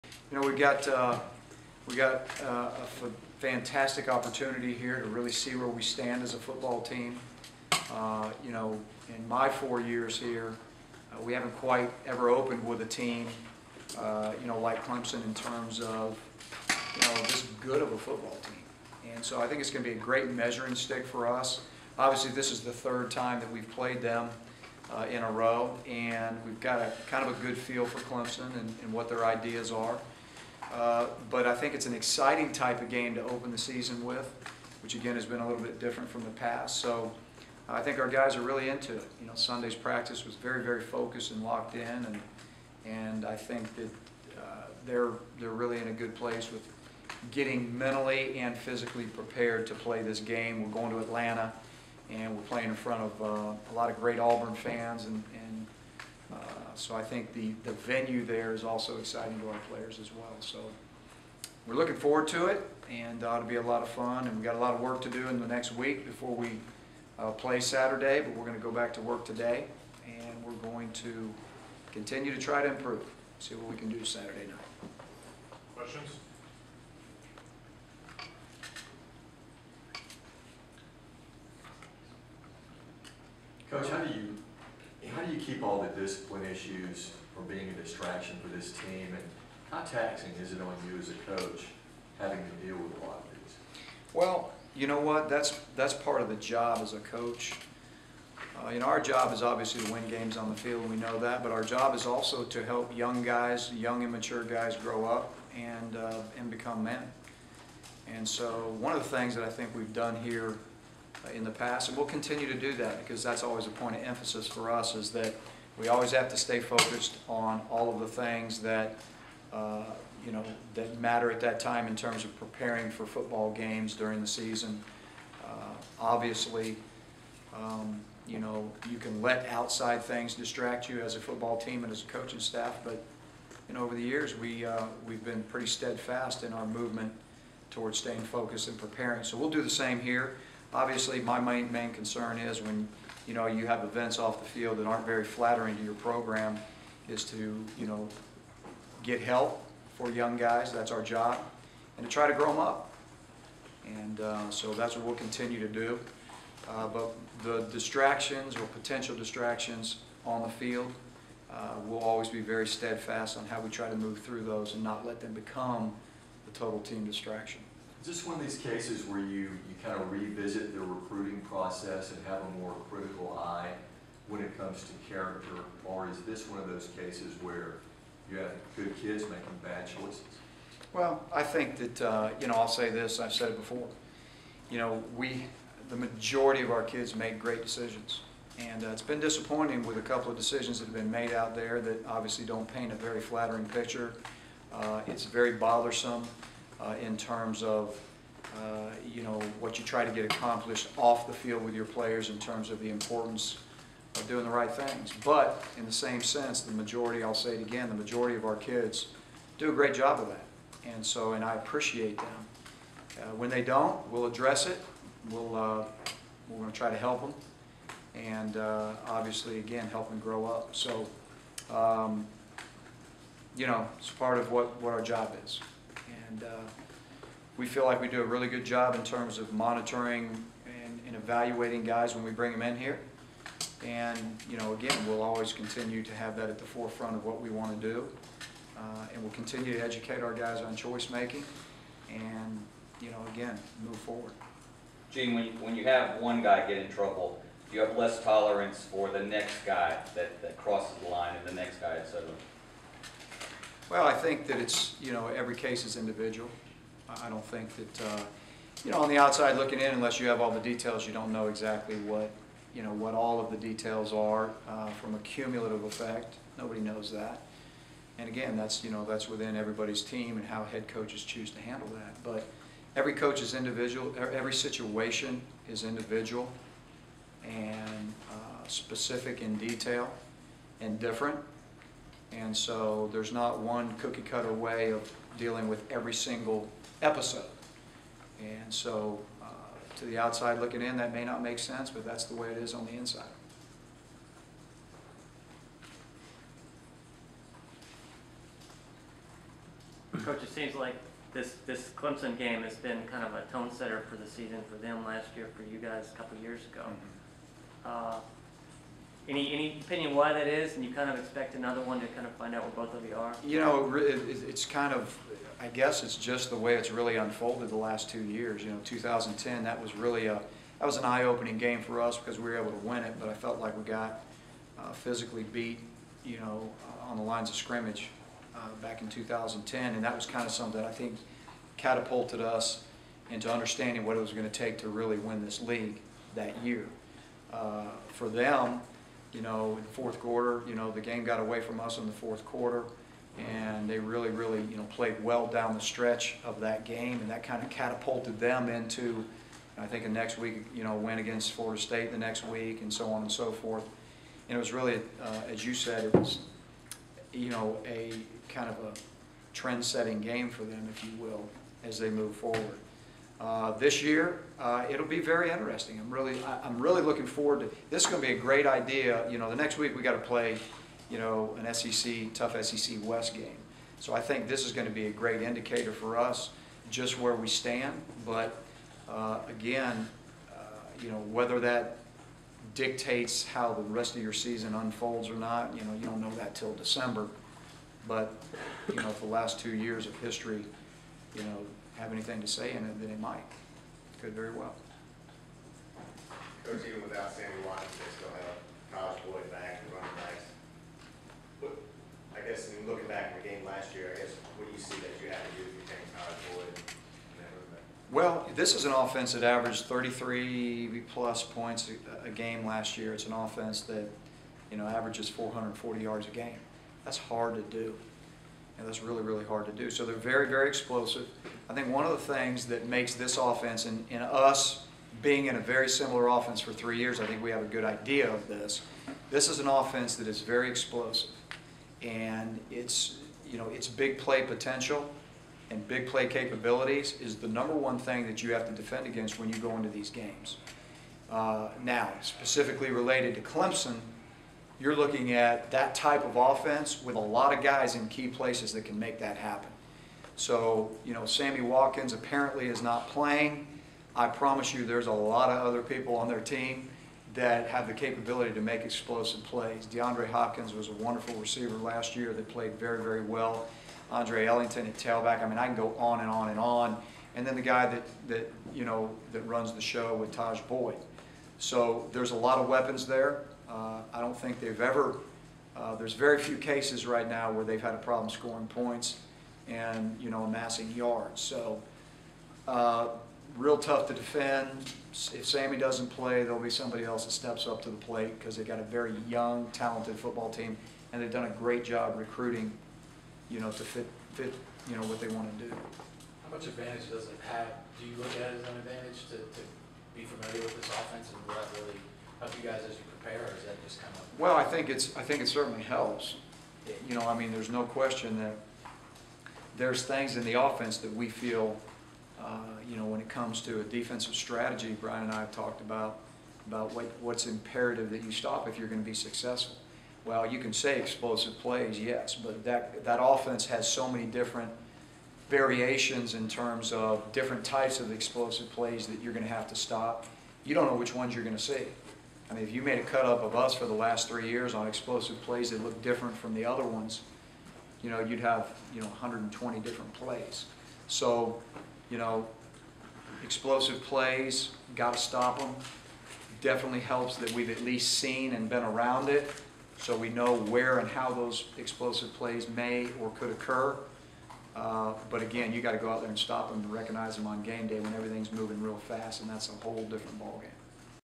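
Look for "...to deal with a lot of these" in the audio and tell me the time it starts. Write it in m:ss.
1:32.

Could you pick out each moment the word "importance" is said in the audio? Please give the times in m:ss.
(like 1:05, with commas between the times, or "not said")
3:22.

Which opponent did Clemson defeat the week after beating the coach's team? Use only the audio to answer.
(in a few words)
Florida State.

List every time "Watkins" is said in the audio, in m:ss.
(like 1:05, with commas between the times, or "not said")
6:37, 7:31.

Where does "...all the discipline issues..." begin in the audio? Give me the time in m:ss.
1:25.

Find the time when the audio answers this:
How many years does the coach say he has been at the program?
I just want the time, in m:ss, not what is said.
0:09.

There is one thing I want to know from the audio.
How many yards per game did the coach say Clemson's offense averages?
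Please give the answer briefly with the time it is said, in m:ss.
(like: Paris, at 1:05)
440, at 6:55.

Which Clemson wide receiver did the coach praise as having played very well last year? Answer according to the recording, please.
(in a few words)
DeAndre Hopkins.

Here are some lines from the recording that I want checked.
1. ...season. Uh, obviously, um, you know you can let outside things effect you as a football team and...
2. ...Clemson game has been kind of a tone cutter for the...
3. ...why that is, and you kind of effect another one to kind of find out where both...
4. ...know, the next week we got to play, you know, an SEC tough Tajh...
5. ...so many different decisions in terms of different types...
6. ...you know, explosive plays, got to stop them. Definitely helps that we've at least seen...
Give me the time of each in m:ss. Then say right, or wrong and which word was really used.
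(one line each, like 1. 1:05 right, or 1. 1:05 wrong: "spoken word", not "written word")
1. 2:04 wrong: "distract", not "effect"
2. 5:01 wrong: "setter", not "cutter"
3. 5:10 wrong: "expect", not "effect"
4. 6:09 wrong: "SEC", not "Tajh"
5. 8:43 wrong: "variations", not "decisions"
6. 9:02 right.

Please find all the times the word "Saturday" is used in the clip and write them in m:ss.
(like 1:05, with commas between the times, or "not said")
1:07, 1:14.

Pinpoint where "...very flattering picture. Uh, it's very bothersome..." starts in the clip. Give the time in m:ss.
3:12.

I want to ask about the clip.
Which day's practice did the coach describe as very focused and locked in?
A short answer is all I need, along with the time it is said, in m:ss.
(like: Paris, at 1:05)
Sunday, at 0:39.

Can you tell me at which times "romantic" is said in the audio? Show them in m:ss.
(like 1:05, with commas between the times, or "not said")
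not said.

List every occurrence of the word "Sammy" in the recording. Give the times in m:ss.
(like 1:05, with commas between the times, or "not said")
6:37, 7:31, 8:05.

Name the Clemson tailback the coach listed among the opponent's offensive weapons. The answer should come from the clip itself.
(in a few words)
Andre Ellington.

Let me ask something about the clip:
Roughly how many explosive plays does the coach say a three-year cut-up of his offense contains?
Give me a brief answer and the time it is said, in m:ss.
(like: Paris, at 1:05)
120, at 8:59.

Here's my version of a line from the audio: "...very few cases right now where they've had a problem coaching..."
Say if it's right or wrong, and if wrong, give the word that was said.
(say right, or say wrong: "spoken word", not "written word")
wrong: "scoring", not "coaching".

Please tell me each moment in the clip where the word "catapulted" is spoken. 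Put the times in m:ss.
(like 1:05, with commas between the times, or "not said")
5:31, 5:47.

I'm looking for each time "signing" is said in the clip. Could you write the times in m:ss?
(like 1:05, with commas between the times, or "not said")
not said.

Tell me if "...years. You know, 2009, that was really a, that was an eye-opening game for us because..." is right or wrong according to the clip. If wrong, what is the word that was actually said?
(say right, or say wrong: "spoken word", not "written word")
wrong: "2010", not "2009".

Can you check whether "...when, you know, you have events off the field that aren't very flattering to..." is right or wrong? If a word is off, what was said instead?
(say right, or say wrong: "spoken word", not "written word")
right.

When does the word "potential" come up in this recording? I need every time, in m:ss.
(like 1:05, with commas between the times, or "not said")
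2:38, 7:14.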